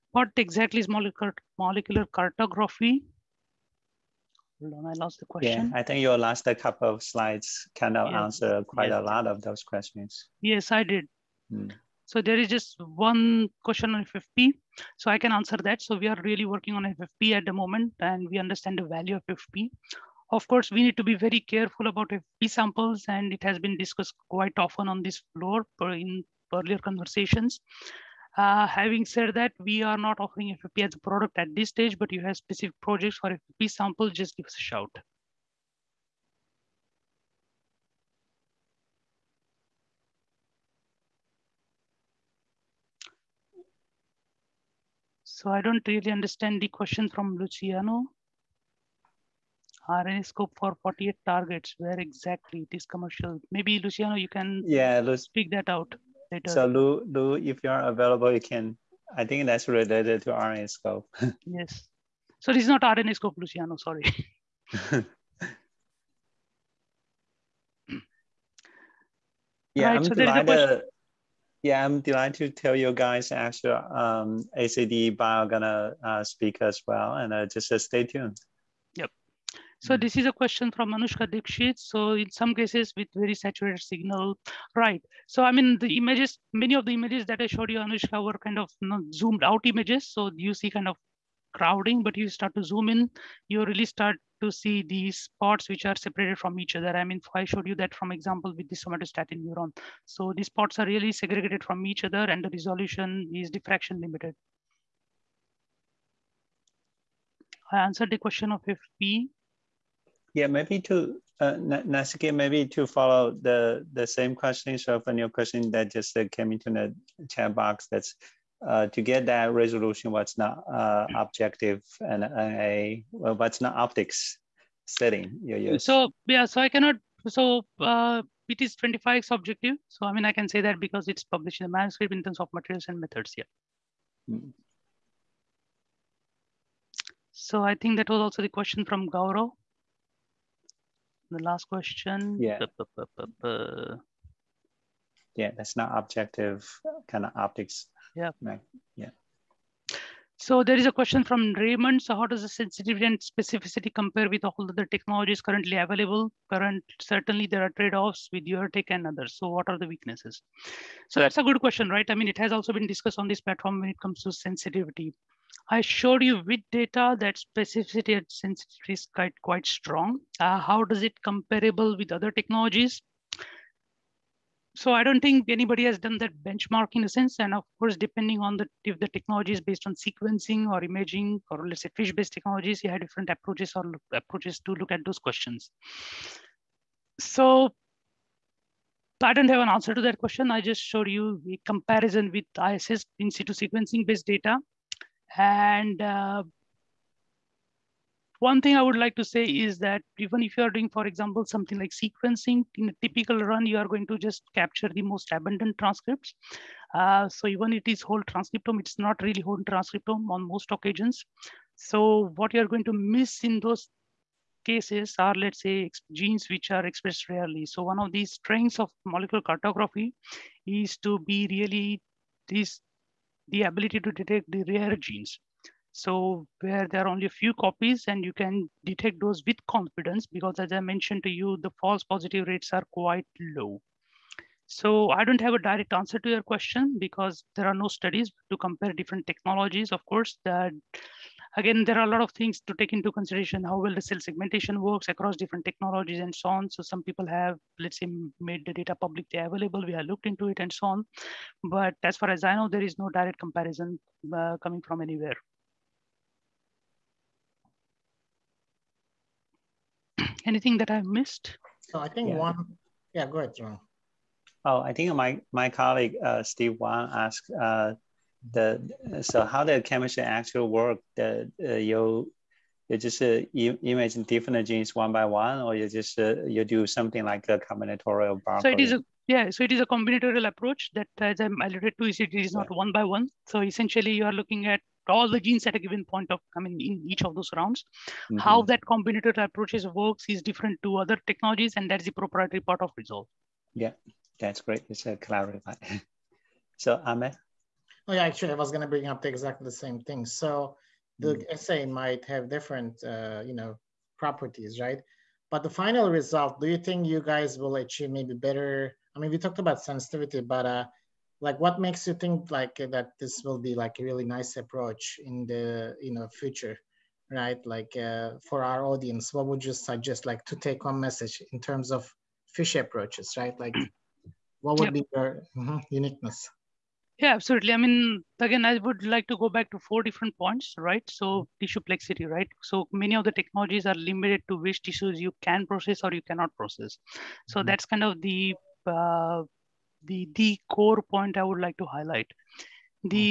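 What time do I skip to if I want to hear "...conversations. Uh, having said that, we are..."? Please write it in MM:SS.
00:26.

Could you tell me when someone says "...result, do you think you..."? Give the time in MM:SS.
05:06.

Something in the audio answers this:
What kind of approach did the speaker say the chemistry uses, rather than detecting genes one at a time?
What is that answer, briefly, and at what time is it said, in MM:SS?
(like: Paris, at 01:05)
combinatorial approach, at 04:39.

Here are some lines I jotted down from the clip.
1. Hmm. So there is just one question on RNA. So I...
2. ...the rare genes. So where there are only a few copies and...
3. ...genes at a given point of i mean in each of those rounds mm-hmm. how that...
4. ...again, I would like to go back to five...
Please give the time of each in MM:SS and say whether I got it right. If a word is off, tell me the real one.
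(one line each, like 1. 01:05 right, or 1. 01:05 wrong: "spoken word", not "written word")
1. 00:11 wrong: "FFP", not "RNA"
2. 03:44 right
3. 04:45 right
4. 05:28 wrong: "four", not "five".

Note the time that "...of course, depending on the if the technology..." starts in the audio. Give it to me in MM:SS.
02:57.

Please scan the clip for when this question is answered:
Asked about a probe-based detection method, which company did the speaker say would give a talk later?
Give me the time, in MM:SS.
01:14.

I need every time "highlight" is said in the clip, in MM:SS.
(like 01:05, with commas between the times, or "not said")
05:41.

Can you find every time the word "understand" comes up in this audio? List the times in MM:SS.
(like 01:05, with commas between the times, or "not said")
00:18, 00:46.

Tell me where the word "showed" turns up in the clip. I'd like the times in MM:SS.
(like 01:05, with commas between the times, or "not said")
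01:27, 01:37, 02:45, 03:10.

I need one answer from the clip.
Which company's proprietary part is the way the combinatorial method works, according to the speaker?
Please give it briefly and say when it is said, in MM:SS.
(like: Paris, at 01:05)
Resolve, at 04:52.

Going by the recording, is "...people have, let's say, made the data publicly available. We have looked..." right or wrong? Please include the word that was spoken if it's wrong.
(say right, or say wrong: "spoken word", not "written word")
right.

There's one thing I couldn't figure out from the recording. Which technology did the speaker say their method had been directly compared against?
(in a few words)
in situ sequencing.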